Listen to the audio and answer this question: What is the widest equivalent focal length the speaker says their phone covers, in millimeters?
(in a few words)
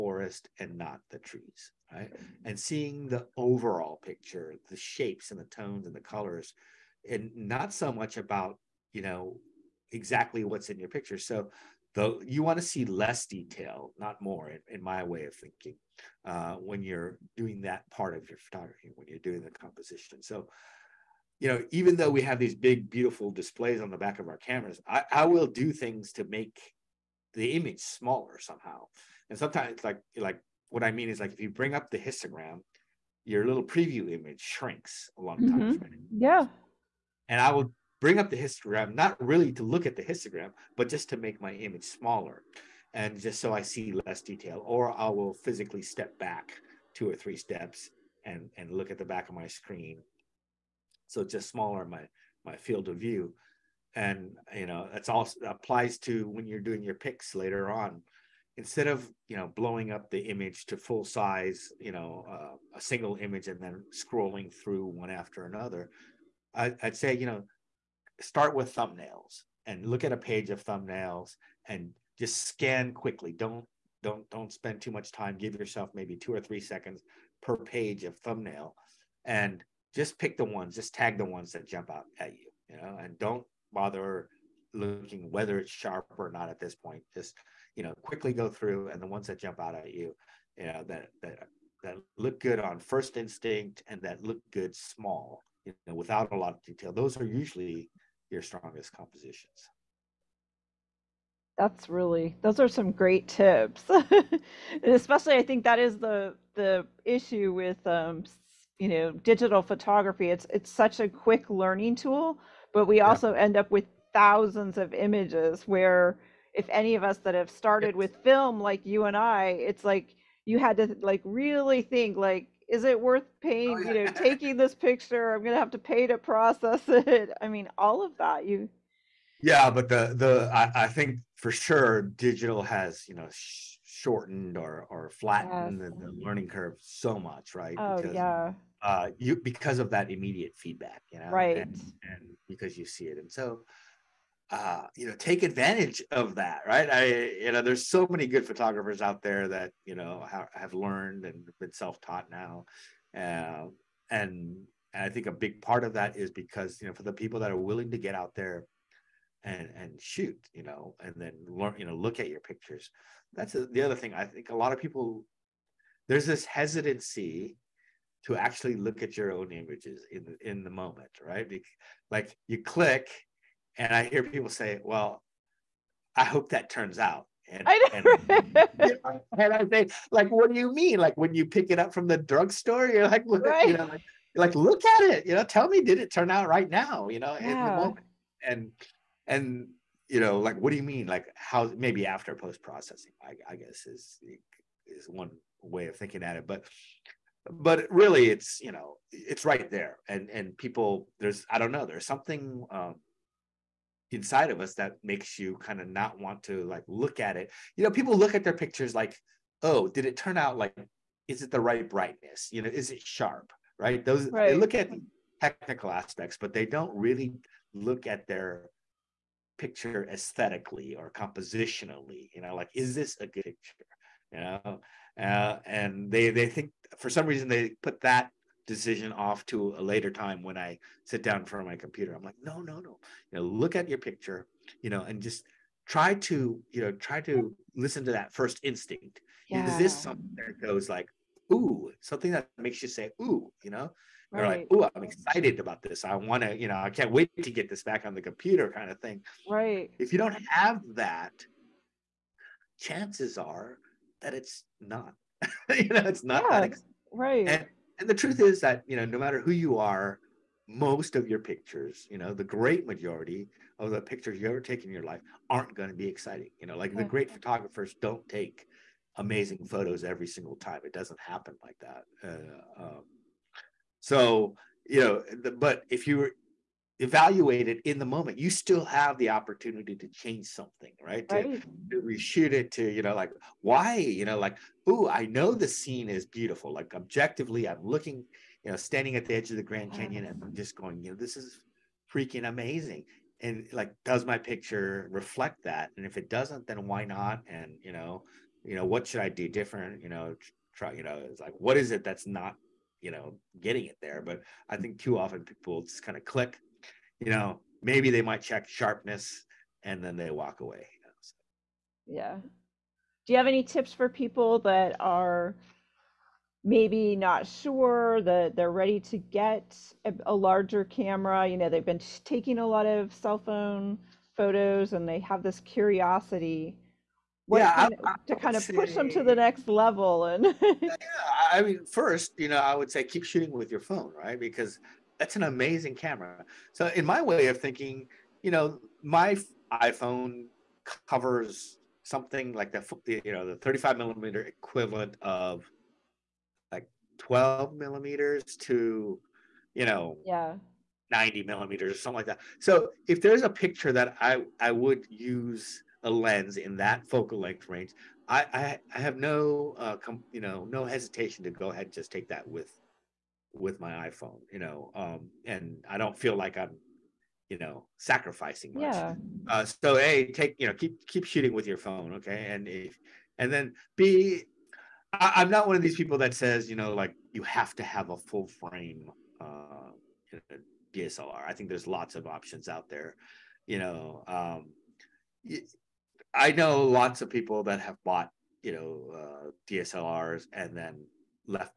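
12 millimeters.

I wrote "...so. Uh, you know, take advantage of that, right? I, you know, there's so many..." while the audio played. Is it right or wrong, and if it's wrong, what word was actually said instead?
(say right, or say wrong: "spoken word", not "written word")
right.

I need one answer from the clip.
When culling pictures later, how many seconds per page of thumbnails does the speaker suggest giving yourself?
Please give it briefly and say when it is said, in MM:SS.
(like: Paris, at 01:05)
2 or 3 seconds, at 01:16.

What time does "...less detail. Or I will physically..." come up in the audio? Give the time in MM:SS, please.
00:44.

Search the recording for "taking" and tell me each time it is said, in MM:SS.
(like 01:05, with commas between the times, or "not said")
02:04, 05:22.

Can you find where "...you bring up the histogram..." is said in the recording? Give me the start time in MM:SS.
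00:31.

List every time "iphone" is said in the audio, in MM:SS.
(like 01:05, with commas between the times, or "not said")
05:39, 06:04.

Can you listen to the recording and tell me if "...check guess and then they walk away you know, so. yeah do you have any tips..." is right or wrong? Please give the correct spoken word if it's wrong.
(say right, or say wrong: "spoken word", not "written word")
wrong: "sharpness", not "guess".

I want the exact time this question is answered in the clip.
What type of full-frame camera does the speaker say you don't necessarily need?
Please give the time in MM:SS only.
06:20.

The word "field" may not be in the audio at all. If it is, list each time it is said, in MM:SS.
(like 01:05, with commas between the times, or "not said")
00:52.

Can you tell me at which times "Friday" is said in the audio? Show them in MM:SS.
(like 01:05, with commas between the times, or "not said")
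not said.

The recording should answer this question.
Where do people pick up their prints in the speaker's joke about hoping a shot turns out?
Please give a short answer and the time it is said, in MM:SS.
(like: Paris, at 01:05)
drugstore, at 03:02.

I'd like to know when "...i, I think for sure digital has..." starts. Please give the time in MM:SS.
02:10.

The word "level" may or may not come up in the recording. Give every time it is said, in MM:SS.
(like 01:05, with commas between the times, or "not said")
05:29.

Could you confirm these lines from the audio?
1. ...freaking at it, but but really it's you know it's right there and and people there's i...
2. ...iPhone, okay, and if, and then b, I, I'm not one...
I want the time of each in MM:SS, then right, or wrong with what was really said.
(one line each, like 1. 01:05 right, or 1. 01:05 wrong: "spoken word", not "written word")
1. 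03:15 wrong: "thinking", not "freaking"
2. 06:11 wrong: "phone", not "iPhone".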